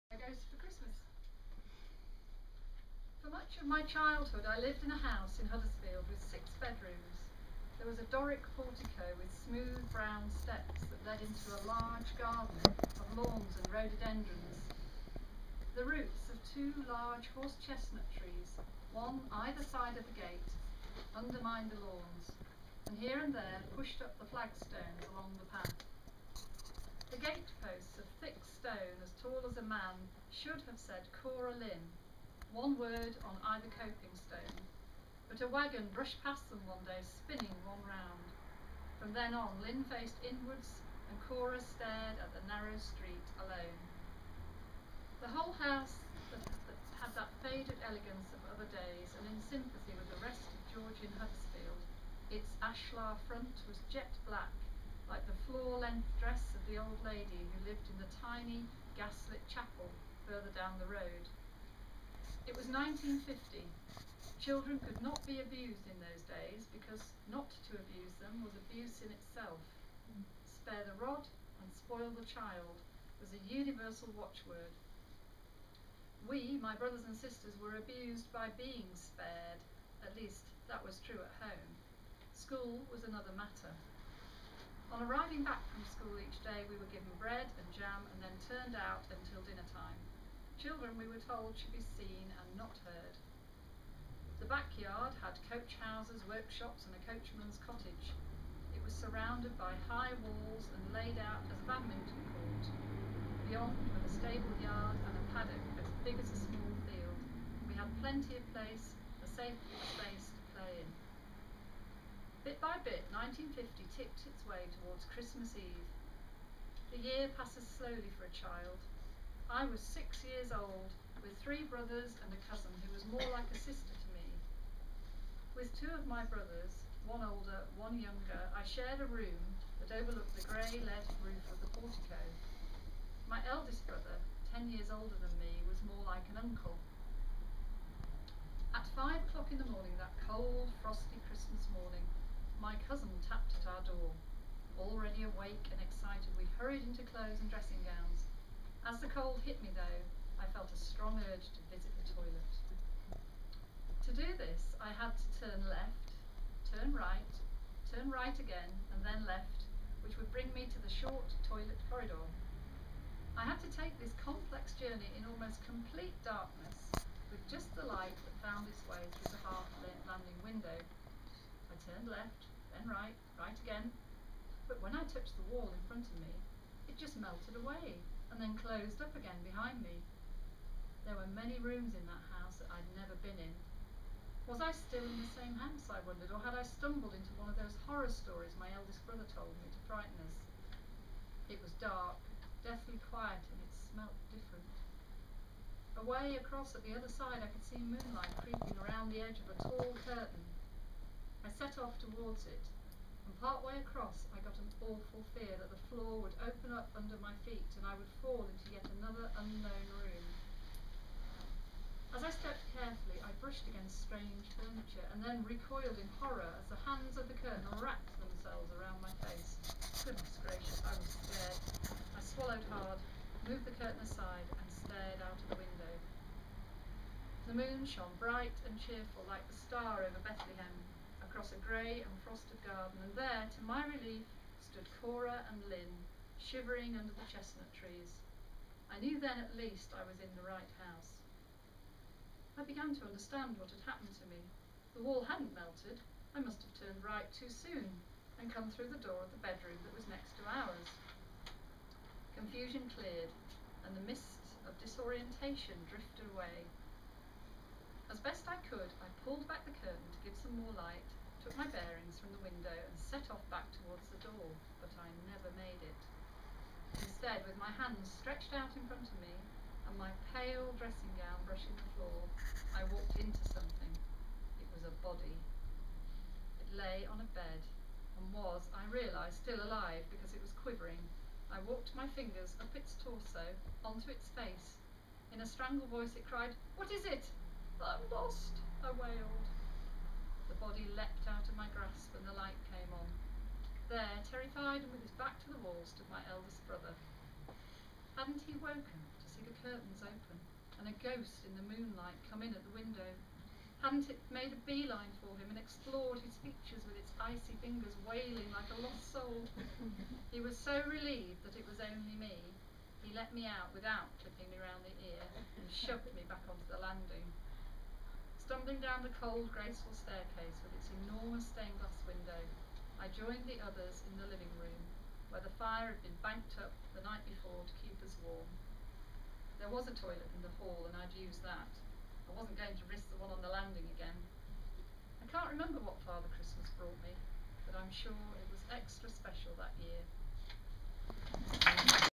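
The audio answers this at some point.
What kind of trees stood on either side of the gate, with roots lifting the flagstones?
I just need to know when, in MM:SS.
00:17.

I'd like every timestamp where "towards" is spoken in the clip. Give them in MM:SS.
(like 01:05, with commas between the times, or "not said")
01:54, 03:22, 04:23.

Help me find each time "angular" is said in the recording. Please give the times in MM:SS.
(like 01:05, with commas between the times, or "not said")
not said.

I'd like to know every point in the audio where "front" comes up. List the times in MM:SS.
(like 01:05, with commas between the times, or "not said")
00:53, 02:55, 04:28.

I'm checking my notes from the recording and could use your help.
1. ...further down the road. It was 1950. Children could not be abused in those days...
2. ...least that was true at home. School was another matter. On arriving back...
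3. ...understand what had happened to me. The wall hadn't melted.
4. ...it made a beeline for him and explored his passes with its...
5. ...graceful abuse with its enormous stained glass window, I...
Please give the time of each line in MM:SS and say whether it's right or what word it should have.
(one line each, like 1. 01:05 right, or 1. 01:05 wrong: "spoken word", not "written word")
1. 01:00 right
2. 01:20 right
3. 04:03 right
4. 05:04 wrong: "features", not "passes"
5. 05:19 wrong: "staircase", not "abuse".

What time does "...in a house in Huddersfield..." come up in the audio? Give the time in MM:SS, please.
00:04.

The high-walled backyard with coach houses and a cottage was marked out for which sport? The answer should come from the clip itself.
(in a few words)
Badminton.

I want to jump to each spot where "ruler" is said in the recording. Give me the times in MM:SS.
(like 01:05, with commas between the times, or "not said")
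not said.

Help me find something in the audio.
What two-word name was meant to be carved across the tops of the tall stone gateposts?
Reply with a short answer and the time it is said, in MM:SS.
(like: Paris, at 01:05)
Cora Lynn, at 00:31.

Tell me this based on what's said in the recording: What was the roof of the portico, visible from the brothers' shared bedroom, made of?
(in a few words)
Lead.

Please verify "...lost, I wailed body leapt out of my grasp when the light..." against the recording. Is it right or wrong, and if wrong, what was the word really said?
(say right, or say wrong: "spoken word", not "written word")
right.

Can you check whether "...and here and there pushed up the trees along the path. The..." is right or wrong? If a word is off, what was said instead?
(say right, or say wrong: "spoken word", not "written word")
wrong: "flagstones", not "trees".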